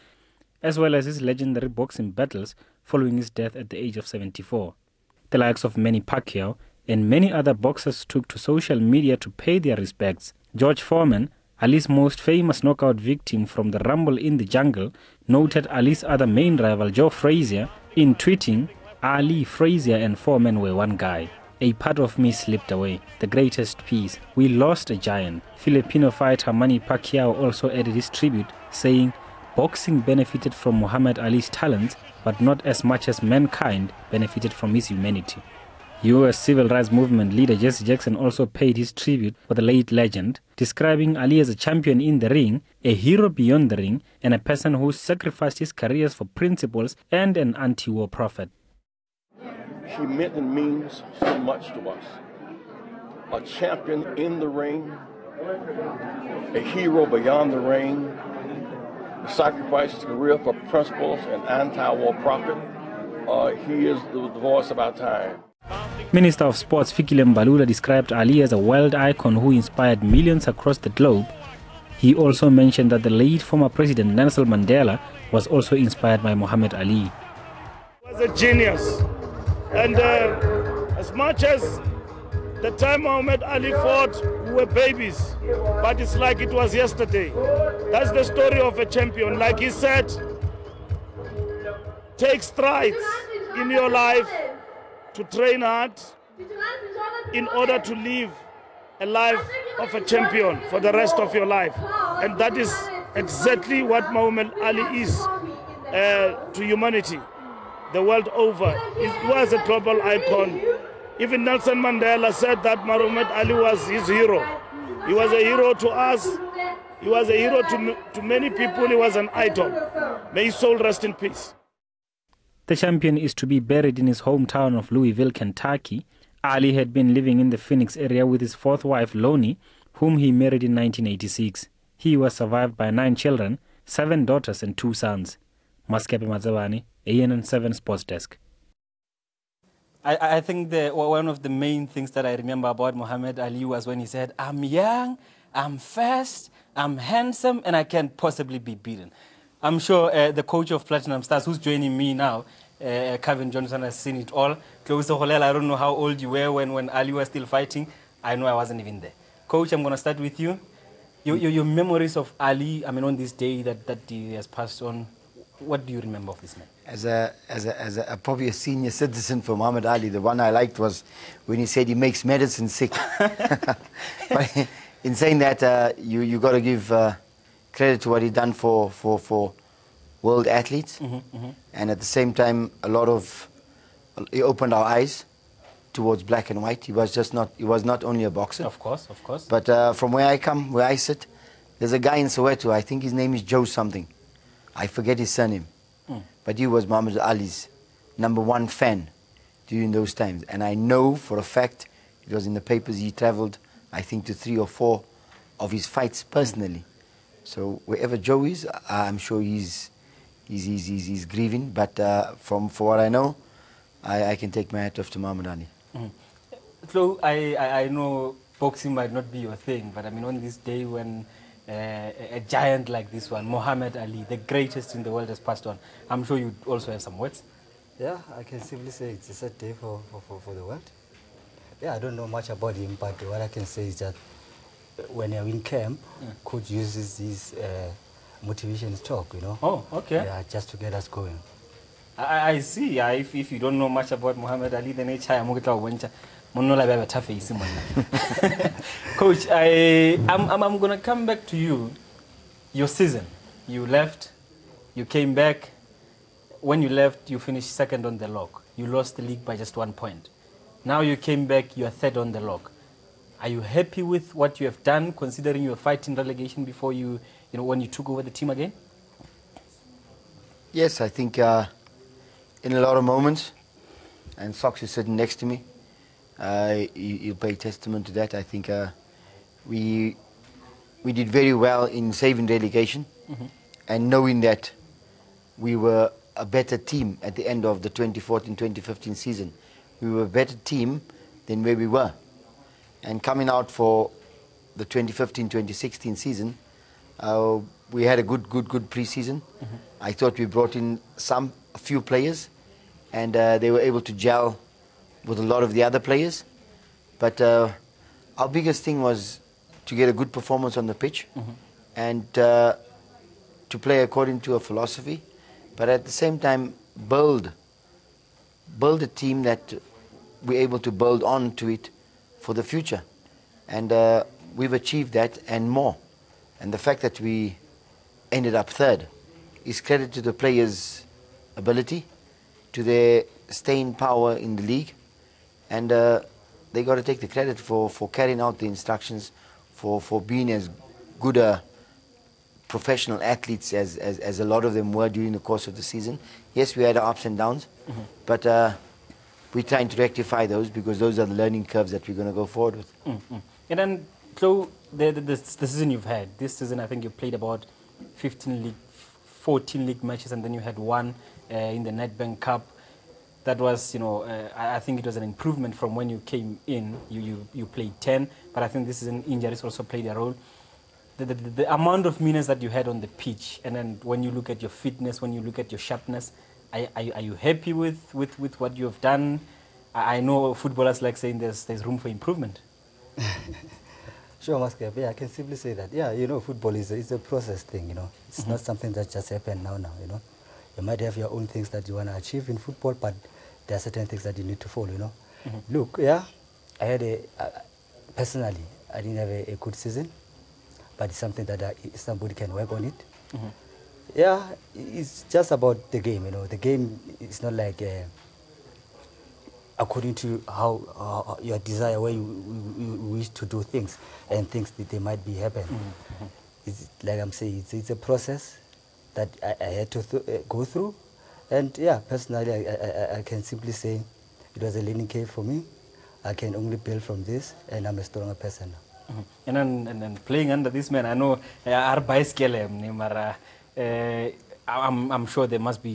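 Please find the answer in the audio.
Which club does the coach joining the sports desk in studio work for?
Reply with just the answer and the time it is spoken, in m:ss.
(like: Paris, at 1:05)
Platinum Stars, at 2:30.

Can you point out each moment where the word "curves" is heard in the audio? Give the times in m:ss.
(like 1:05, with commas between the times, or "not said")
5:51, 7:05.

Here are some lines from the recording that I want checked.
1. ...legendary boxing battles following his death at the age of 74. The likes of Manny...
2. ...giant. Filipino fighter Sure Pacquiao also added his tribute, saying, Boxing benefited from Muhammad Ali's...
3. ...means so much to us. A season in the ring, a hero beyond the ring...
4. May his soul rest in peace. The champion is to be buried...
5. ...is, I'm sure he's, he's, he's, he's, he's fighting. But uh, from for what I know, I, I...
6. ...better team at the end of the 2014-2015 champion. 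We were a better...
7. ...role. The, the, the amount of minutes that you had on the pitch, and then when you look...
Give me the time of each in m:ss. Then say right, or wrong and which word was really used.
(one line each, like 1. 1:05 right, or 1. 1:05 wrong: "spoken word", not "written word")
1. 0:01 right
2. 0:24 wrong: "Manny", not "Sure"
3. 0:50 wrong: "champion", not "season"
4. 2:00 right
5. 3:28 wrong: "grieving", not "fighting"
6. 4:46 wrong: "season", not "champion"
7. 6:10 right.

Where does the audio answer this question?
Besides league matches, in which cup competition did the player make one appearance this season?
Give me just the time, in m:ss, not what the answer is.
6:01.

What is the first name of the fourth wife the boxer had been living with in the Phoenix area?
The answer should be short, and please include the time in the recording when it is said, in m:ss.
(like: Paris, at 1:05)
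Loni, at 2:09.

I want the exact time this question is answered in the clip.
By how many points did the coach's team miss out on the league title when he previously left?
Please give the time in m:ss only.
4:19.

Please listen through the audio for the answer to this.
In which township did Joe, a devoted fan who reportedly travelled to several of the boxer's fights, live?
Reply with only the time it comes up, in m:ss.
3:12.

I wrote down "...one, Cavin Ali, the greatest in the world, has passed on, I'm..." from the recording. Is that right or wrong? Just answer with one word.
wrong.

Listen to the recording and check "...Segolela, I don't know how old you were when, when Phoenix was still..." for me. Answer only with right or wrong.
wrong.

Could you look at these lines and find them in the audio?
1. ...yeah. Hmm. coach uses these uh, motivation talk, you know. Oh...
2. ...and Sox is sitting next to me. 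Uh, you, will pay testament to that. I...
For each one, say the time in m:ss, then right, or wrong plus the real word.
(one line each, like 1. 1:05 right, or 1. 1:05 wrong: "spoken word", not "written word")
1. 3:56 right
2. 4:34 right.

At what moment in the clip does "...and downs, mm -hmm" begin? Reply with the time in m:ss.
5:47.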